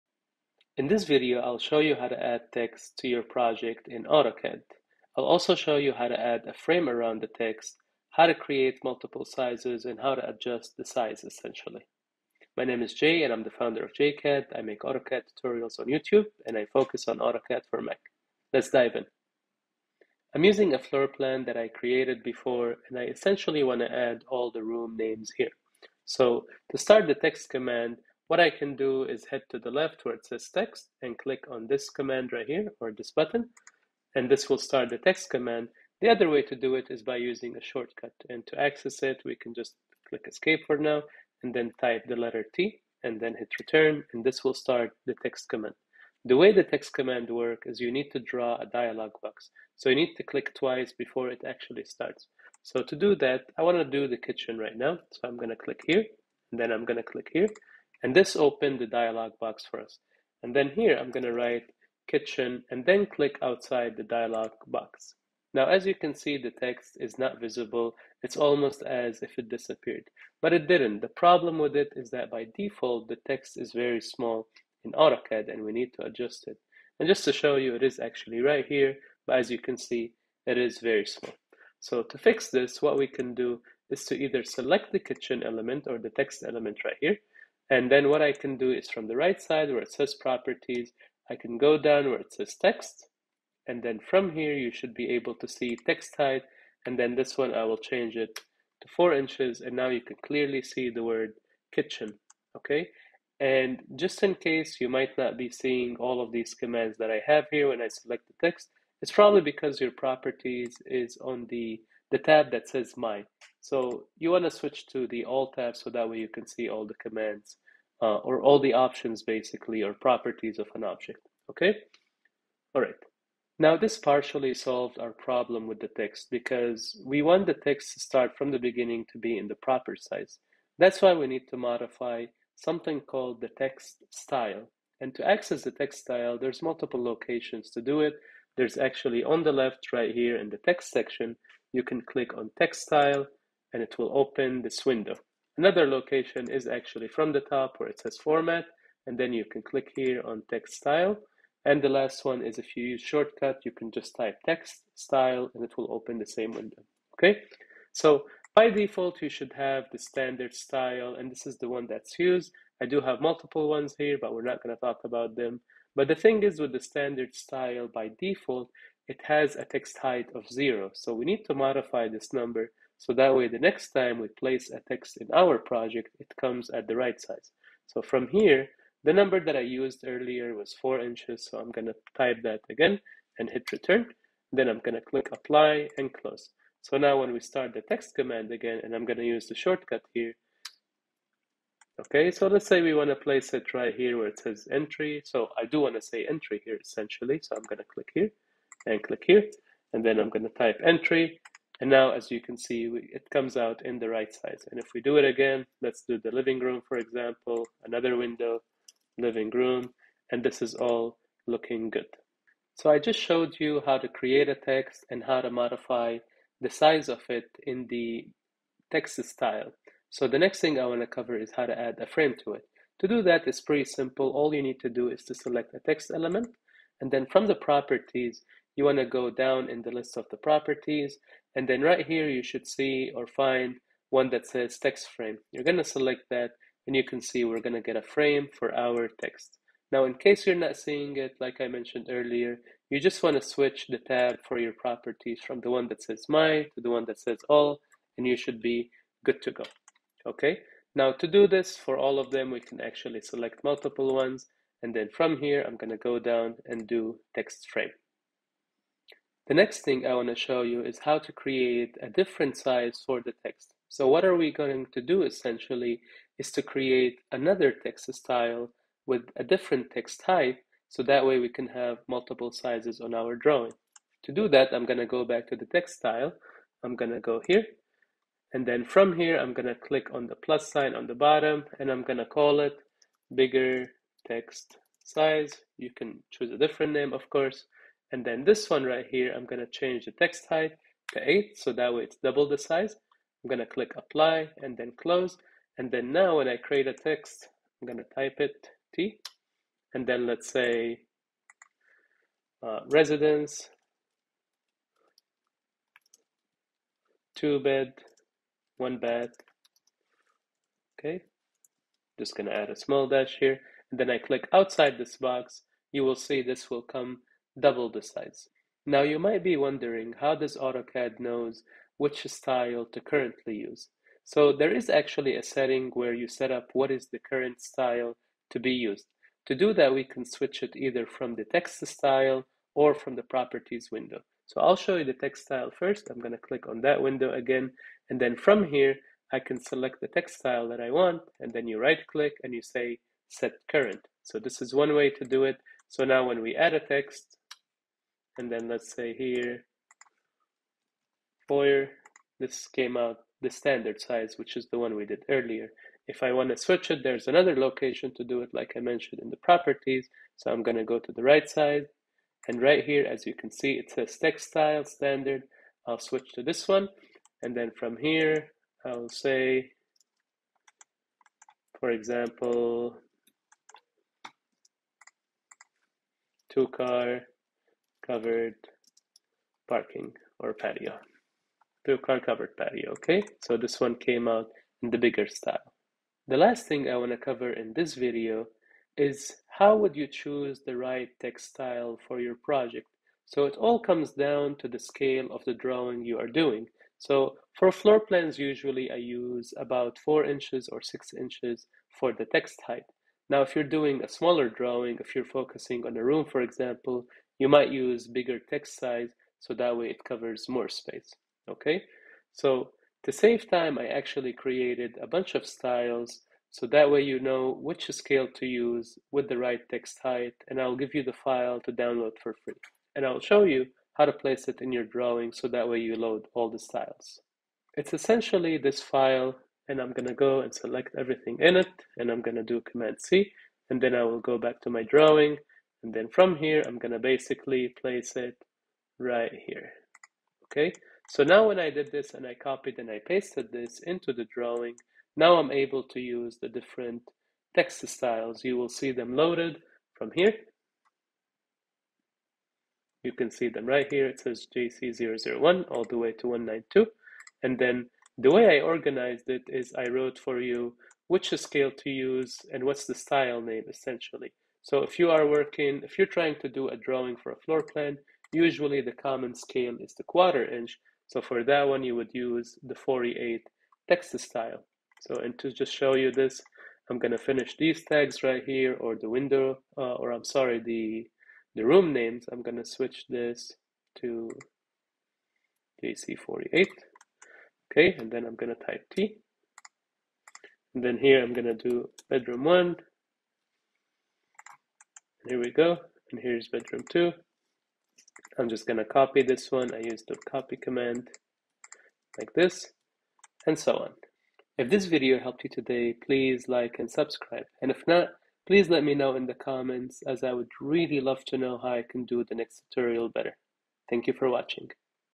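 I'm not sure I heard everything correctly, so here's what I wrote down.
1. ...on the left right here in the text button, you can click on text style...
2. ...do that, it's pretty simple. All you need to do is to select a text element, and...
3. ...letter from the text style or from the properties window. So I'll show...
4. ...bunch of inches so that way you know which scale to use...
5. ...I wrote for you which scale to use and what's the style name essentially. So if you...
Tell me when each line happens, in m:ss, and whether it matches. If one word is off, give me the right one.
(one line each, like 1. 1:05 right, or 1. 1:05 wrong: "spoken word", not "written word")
1. 2:19 wrong: "section", not "button"
2. 3:43 right
3. 5:30 wrong: "either", not "letter"
4. 6:55 wrong: "styles", not "inches"
5. 7:39 right.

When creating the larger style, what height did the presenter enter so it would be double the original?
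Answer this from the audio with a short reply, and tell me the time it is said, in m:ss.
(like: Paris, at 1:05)
8, at 4:51.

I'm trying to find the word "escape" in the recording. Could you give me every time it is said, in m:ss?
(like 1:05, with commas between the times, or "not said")
0:40.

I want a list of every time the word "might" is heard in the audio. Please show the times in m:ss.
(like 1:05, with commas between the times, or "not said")
1:44, 5:19, 6:47.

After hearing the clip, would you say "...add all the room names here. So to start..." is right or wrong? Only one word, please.
right.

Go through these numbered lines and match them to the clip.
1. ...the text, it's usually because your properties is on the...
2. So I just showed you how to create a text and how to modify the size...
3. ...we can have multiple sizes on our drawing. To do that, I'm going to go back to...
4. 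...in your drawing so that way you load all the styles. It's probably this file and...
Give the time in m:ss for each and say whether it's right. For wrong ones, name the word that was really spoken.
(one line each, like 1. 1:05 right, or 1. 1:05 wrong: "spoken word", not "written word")
1. 1:48 wrong: "probably", not "usually"
2. 3:32 right
3. 4:31 right
4. 7:04 wrong: "essentially", not "probably".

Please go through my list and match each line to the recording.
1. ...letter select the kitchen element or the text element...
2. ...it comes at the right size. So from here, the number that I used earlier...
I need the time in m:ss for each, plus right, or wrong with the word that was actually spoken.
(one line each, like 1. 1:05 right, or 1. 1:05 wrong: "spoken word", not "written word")
1. 1:24 wrong: "either", not "letter"
2. 2:56 right.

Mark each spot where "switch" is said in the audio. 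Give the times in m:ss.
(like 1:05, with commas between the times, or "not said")
1:54, 4:03, 5:30, 5:56, 6:05, 8:02.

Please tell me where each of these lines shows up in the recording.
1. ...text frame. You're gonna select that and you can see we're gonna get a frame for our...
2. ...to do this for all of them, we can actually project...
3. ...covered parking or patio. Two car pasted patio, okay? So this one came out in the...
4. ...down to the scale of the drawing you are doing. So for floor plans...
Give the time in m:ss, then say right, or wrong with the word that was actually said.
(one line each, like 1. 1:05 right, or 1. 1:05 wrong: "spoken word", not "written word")
1. 3:54 right
2. 4:11 wrong: "select", not "project"
3. 6:18 wrong: "covered", not "pasted"
4. 6:34 right.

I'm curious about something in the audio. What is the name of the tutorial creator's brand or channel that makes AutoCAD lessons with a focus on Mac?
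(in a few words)
JCAD.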